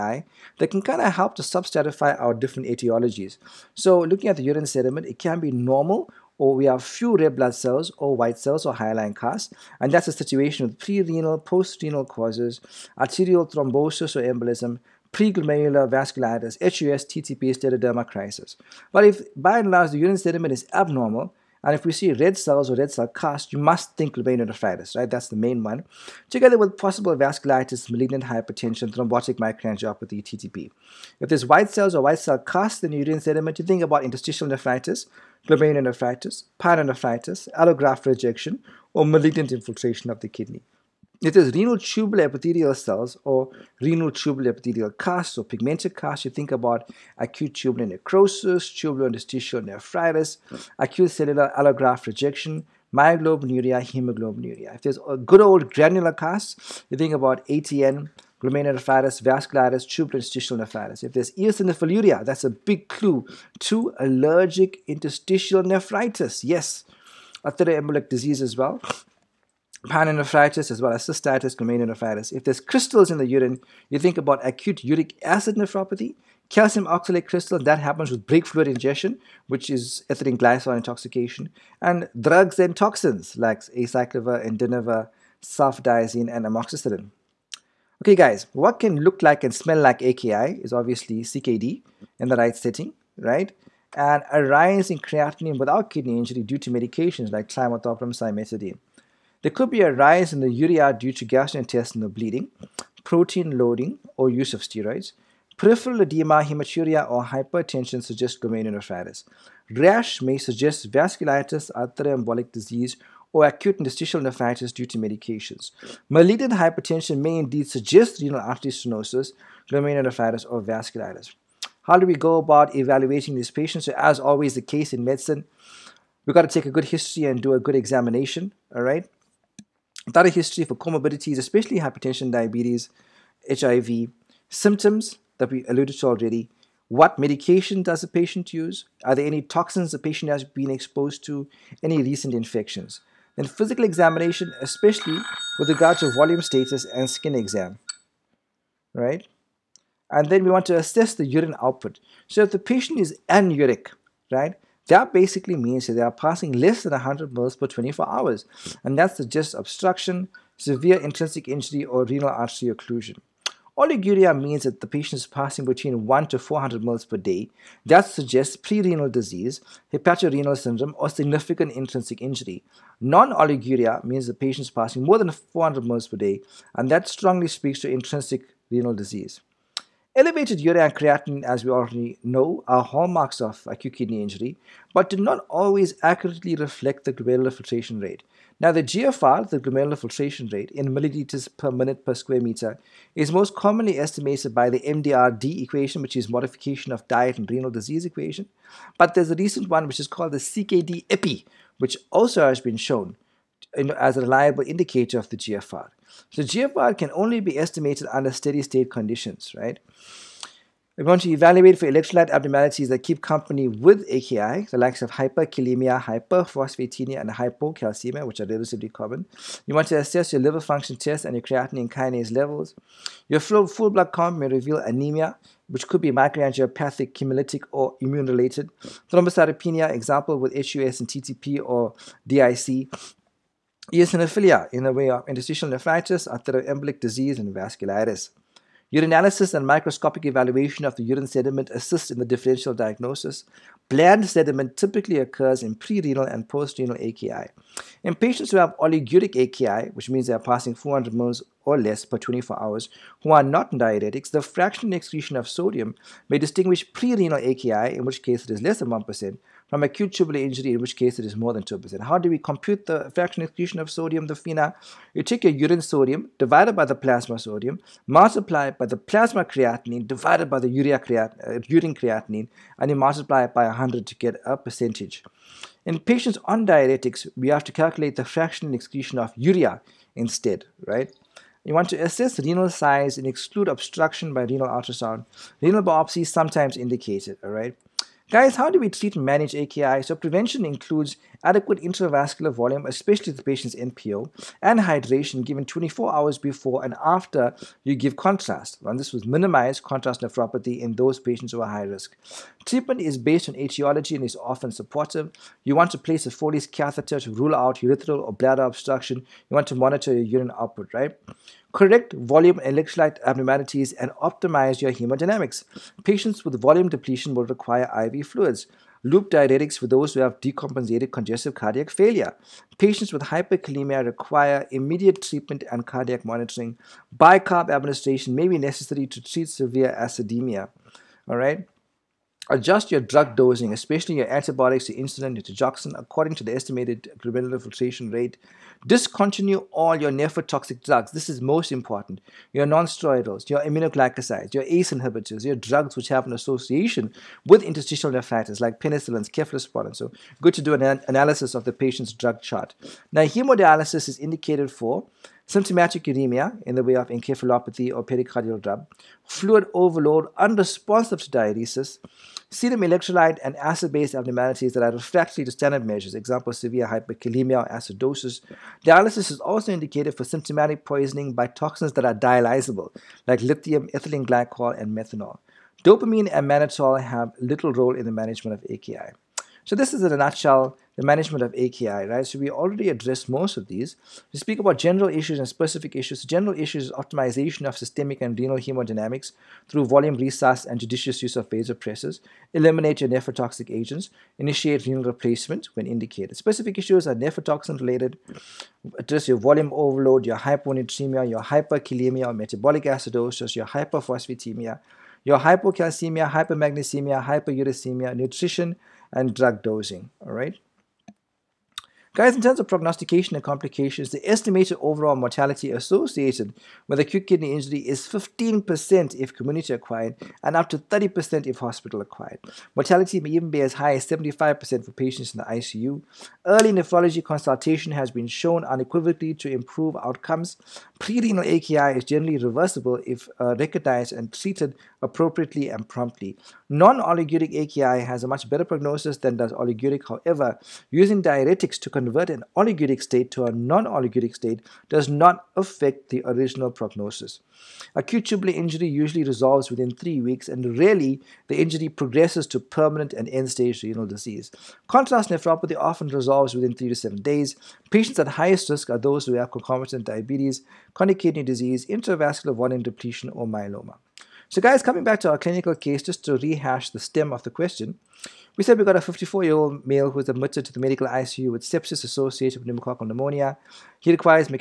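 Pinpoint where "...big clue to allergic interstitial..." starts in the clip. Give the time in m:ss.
1:02.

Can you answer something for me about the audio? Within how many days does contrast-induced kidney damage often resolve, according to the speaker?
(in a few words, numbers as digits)
3 to 7 days.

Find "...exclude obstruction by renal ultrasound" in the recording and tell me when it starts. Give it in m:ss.
4:43.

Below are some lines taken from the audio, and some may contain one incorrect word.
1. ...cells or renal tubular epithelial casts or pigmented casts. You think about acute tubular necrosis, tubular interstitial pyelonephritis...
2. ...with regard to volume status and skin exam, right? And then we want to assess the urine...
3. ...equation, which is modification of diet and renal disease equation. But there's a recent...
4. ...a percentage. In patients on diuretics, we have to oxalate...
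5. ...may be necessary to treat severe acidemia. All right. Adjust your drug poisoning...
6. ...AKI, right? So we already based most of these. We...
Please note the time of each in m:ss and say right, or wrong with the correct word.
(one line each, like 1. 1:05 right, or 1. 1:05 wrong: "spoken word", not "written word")
1. 0:42 wrong: "nephritis", not "pyelonephritis"
2. 2:25 right
3. 3:15 right
4. 4:34 wrong: "calculate", not "oxalate"
5. 5:28 wrong: "dosing", not "poisoning"
6. 6:21 wrong: "addressed", not "based".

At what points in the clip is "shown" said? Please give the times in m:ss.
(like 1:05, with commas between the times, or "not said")
3:22, 7:08.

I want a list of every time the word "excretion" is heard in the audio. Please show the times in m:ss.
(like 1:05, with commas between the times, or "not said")
4:14, 4:23, 4:38.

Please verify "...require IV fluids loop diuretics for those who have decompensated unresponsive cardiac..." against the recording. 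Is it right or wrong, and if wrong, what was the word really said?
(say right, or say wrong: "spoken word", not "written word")
wrong: "congestive", not "unresponsive".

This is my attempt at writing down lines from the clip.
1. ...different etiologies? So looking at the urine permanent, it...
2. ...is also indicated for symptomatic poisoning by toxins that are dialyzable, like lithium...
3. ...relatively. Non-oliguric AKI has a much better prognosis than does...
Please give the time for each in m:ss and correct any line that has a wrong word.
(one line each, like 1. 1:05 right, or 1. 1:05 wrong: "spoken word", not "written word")
1. 0:02 wrong: "sediment", not "permanent"
2. 6:09 right
3. 7:15 wrong: "promptly", not "relatively".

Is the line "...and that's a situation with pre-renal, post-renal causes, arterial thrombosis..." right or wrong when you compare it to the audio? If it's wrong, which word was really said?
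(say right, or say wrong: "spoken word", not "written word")
right.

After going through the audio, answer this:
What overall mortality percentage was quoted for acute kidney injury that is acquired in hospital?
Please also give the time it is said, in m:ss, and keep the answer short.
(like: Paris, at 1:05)
30%, at 7:00.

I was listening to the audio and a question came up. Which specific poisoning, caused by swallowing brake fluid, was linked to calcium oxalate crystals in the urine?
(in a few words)
Ethylene glycol intoxication.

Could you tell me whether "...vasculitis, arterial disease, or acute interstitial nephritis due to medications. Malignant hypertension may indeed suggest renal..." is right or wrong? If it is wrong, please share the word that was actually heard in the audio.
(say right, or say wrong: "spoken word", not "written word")
right.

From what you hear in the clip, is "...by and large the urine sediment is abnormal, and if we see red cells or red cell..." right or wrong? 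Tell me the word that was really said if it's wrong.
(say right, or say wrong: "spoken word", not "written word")
right.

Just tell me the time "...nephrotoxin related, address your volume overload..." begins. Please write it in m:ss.
6:37.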